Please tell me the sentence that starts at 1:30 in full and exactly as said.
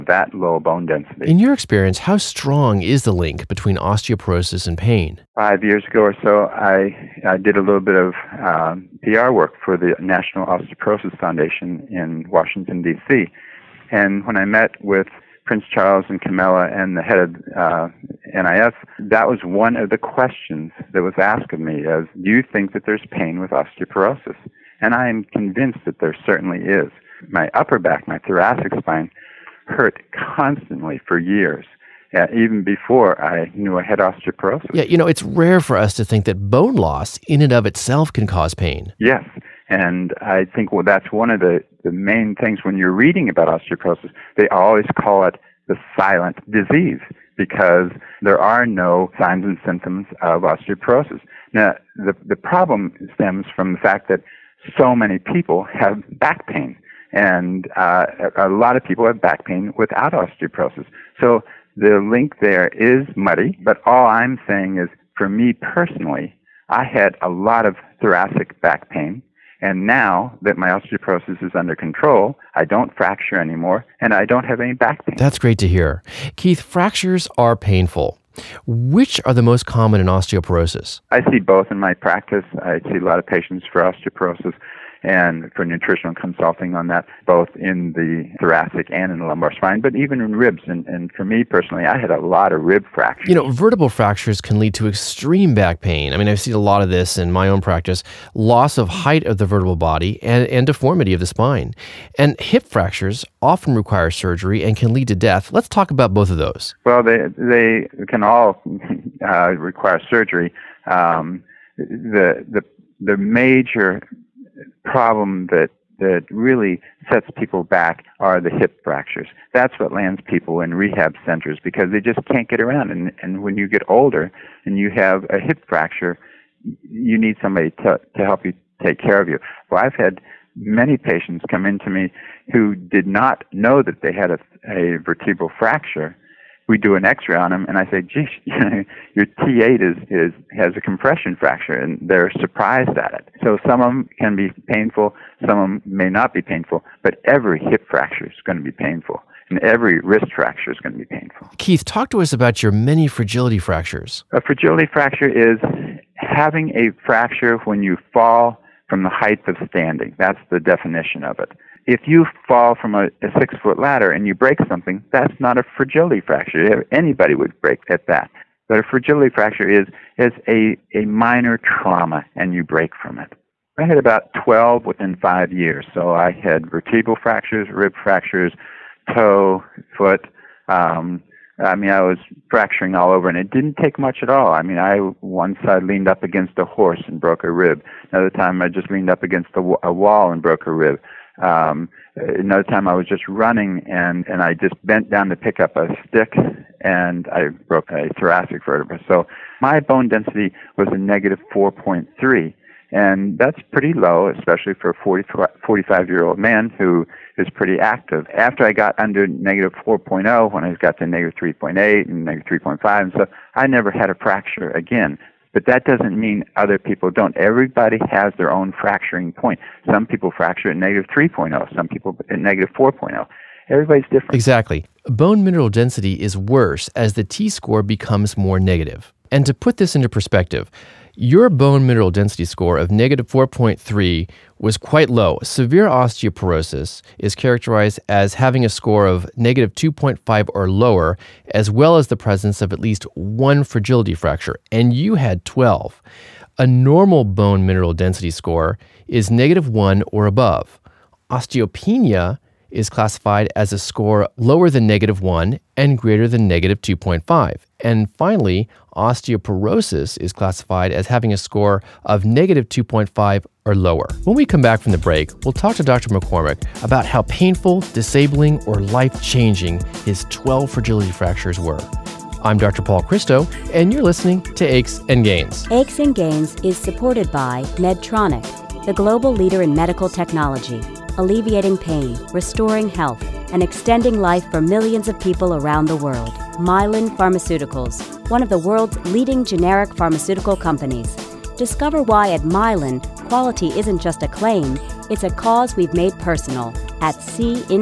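And, and for me personally, I had a lot of rib fractures.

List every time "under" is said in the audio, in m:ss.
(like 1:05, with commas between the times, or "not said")
1:11, 3:28.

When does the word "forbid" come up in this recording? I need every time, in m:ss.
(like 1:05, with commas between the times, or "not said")
not said.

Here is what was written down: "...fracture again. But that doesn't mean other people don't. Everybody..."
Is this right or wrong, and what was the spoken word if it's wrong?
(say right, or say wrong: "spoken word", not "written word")
right.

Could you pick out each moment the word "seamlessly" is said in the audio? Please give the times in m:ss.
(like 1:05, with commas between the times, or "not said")
not said.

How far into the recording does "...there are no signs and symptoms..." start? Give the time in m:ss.
0:48.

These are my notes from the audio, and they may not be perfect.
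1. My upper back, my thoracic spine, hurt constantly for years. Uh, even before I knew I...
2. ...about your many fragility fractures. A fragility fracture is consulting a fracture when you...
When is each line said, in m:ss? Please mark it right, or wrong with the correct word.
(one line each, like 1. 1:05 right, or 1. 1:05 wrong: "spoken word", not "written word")
1. 0:27 right
2. 2:32 wrong: "having", not "consulting".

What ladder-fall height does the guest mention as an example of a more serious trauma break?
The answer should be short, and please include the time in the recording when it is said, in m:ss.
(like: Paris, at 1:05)
6 feet, at 2:43.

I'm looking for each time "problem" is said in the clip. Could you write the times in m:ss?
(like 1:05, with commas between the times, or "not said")
0:52, 1:54.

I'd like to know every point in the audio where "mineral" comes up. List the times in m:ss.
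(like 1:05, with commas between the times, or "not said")
3:45, 3:51, 4:07.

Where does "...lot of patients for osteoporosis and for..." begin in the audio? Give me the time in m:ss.
1:23.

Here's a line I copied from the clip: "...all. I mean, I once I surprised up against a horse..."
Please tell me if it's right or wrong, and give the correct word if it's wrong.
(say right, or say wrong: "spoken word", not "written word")
wrong: "leaned", not "surprised".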